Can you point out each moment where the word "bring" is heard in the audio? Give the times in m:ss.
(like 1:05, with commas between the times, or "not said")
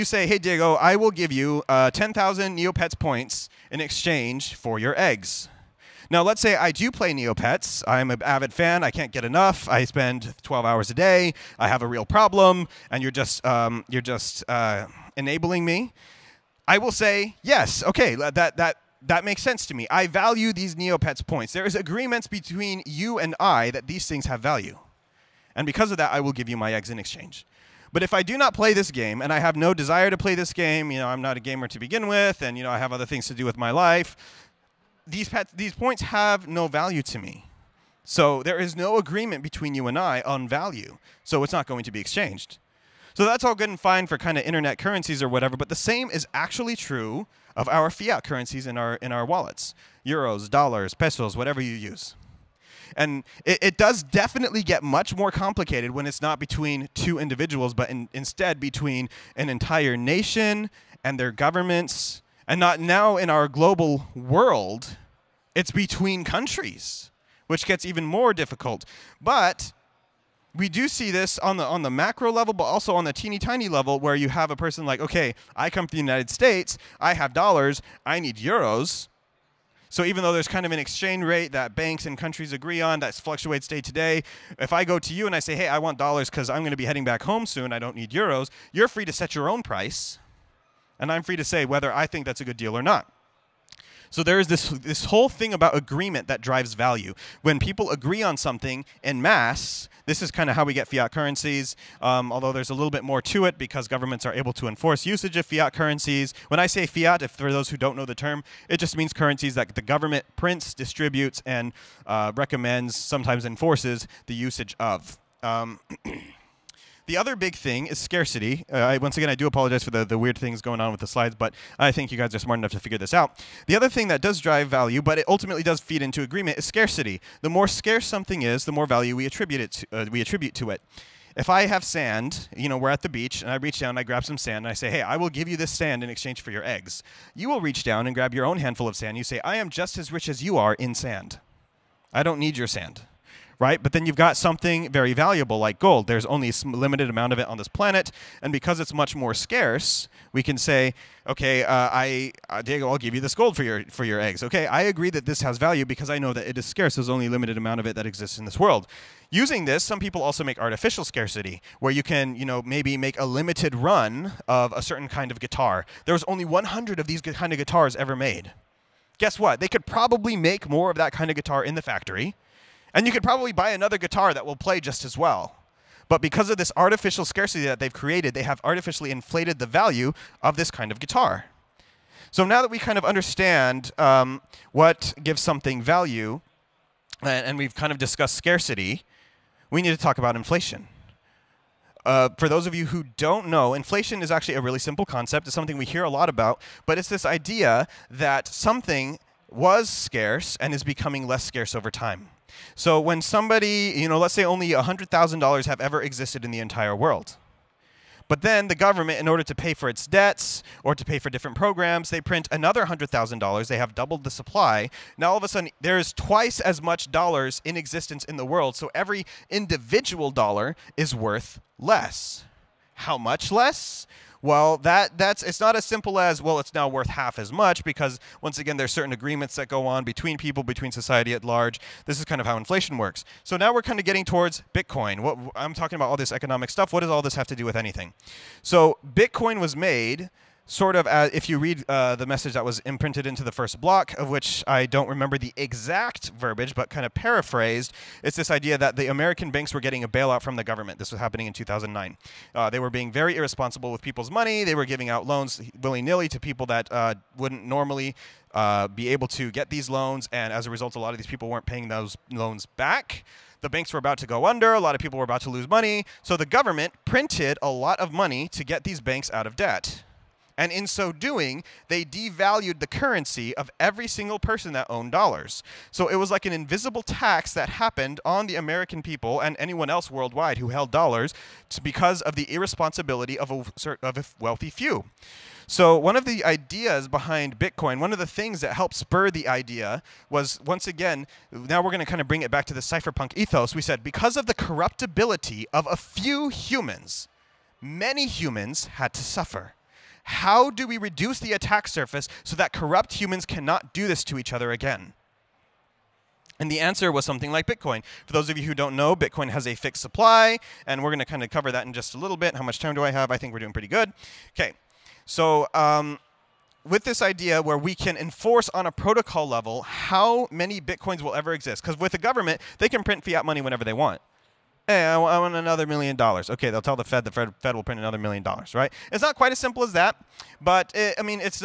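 4:52.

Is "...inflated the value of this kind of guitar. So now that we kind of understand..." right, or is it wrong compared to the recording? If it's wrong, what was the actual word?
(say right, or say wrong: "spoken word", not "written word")
right.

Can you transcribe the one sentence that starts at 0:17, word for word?
Okay, that that that makes sense to me.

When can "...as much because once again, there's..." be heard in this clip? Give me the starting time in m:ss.
3:47.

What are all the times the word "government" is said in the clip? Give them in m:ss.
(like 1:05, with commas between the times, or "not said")
1:01, 1:43, 1:49, 3:28, 4:10, 4:26, 5:22.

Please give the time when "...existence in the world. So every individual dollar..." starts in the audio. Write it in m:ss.
3:37.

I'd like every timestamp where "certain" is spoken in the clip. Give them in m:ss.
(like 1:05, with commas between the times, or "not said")
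2:44, 3:48.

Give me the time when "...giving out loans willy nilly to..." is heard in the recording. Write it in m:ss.
4:14.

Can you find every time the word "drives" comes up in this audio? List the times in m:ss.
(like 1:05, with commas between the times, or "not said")
1:36, 2:04.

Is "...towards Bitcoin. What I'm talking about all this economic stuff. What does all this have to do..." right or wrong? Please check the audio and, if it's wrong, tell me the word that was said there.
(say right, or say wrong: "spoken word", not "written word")
right.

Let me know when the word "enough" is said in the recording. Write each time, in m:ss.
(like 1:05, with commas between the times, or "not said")
0:09, 2:02.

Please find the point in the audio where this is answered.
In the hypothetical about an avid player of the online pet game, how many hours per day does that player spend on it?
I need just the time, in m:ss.
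0:10.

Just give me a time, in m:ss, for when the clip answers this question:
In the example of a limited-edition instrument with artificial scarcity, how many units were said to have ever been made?
2:46.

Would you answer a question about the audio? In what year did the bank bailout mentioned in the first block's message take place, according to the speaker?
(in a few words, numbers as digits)
2009.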